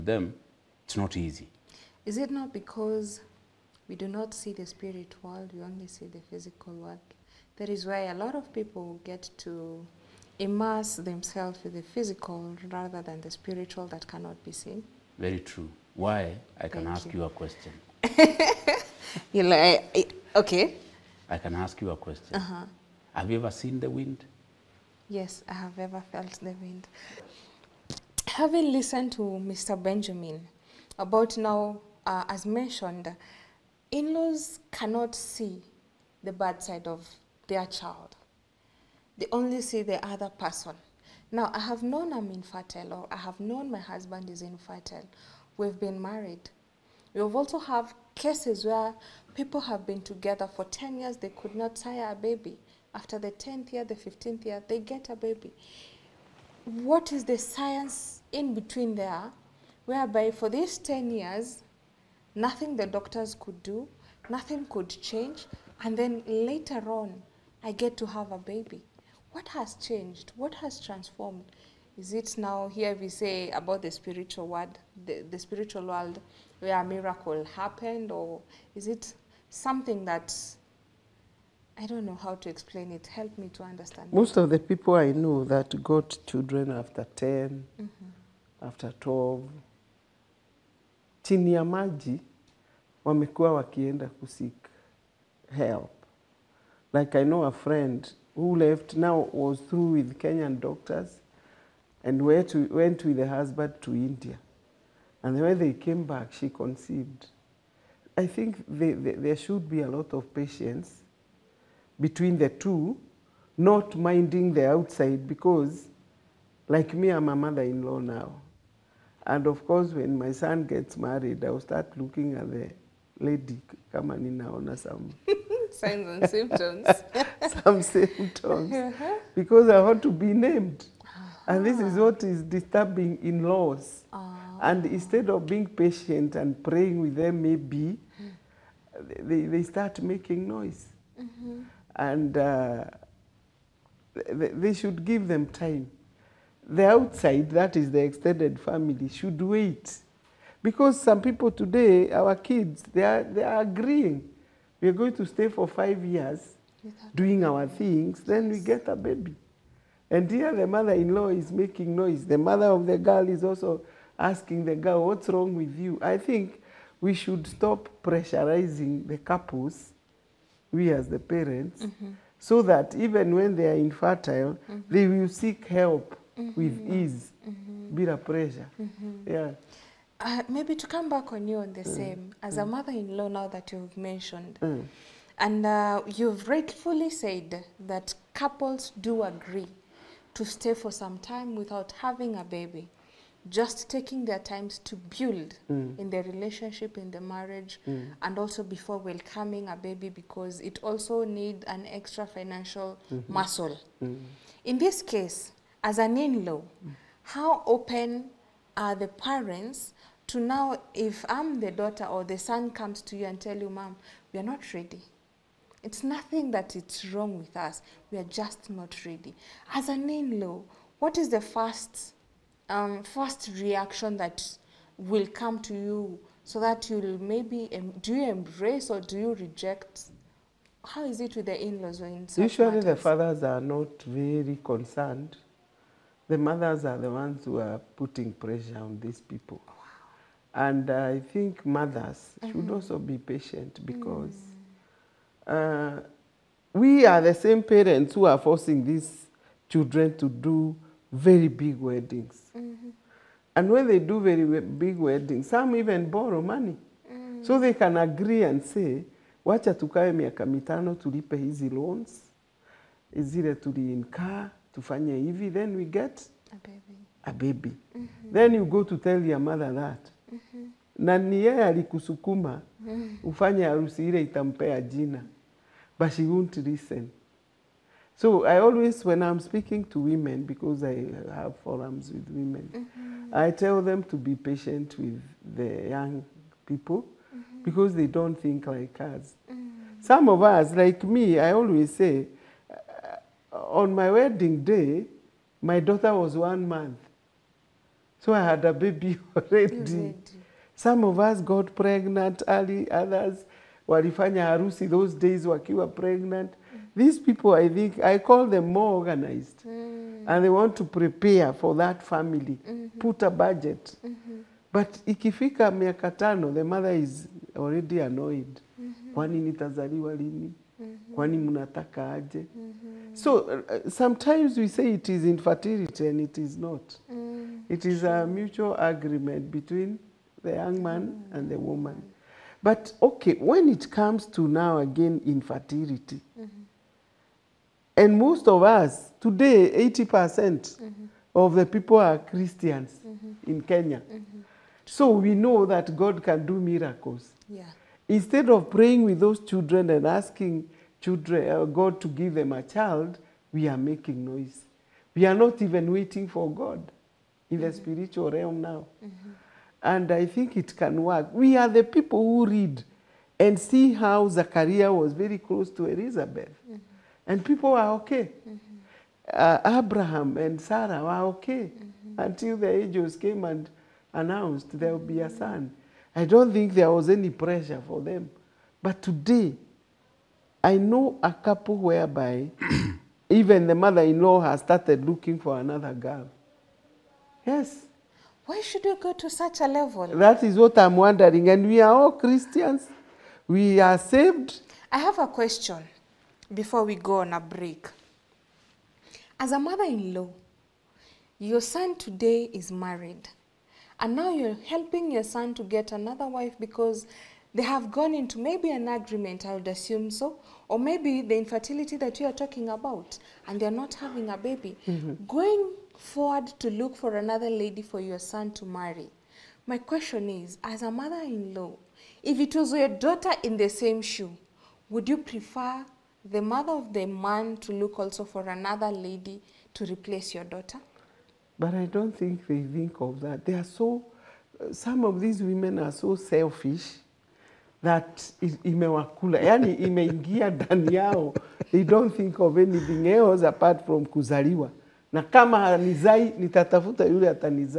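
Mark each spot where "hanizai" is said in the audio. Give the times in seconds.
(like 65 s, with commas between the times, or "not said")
445 s.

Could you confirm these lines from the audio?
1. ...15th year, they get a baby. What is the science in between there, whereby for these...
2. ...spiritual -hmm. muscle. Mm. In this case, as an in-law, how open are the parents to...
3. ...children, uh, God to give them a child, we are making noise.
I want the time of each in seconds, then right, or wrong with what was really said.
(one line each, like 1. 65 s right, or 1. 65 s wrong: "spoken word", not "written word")
1. 53 s right
2. 202 s wrong: "financial", not "spiritual"
3. 351 s right.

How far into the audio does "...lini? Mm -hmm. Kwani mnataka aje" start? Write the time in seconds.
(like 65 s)
320 s.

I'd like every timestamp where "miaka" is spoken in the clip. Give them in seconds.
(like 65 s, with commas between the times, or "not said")
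260 s, 315 s.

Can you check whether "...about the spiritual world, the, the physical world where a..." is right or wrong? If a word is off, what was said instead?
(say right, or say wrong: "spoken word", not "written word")
wrong: "spiritual", not "physical".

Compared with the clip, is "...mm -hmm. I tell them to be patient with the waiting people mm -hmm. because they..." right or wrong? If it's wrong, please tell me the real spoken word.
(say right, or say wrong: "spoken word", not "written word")
wrong: "young", not "waiting".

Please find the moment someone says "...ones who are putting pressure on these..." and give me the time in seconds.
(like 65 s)
237 s.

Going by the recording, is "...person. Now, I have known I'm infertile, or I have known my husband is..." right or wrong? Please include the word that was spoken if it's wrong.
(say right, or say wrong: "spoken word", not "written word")
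right.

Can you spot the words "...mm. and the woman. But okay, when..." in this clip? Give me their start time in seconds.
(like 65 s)
331 s.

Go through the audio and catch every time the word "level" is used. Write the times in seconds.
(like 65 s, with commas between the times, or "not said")
389 s.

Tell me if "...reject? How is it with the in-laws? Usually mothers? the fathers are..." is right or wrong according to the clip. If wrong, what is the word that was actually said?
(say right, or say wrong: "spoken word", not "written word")
wrong: "matters", not "mothers".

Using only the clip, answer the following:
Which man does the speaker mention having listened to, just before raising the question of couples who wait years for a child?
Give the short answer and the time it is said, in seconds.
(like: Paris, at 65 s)
Mr. Benjamin, at 29 s.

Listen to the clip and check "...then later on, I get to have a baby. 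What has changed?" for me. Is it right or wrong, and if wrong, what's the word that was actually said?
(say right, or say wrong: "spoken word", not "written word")
right.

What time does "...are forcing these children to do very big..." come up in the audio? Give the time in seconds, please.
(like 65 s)
248 s.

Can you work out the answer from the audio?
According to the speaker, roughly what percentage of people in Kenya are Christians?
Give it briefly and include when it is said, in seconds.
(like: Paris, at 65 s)
80%, at 339 s.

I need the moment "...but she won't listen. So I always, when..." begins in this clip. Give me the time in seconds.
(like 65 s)
275 s.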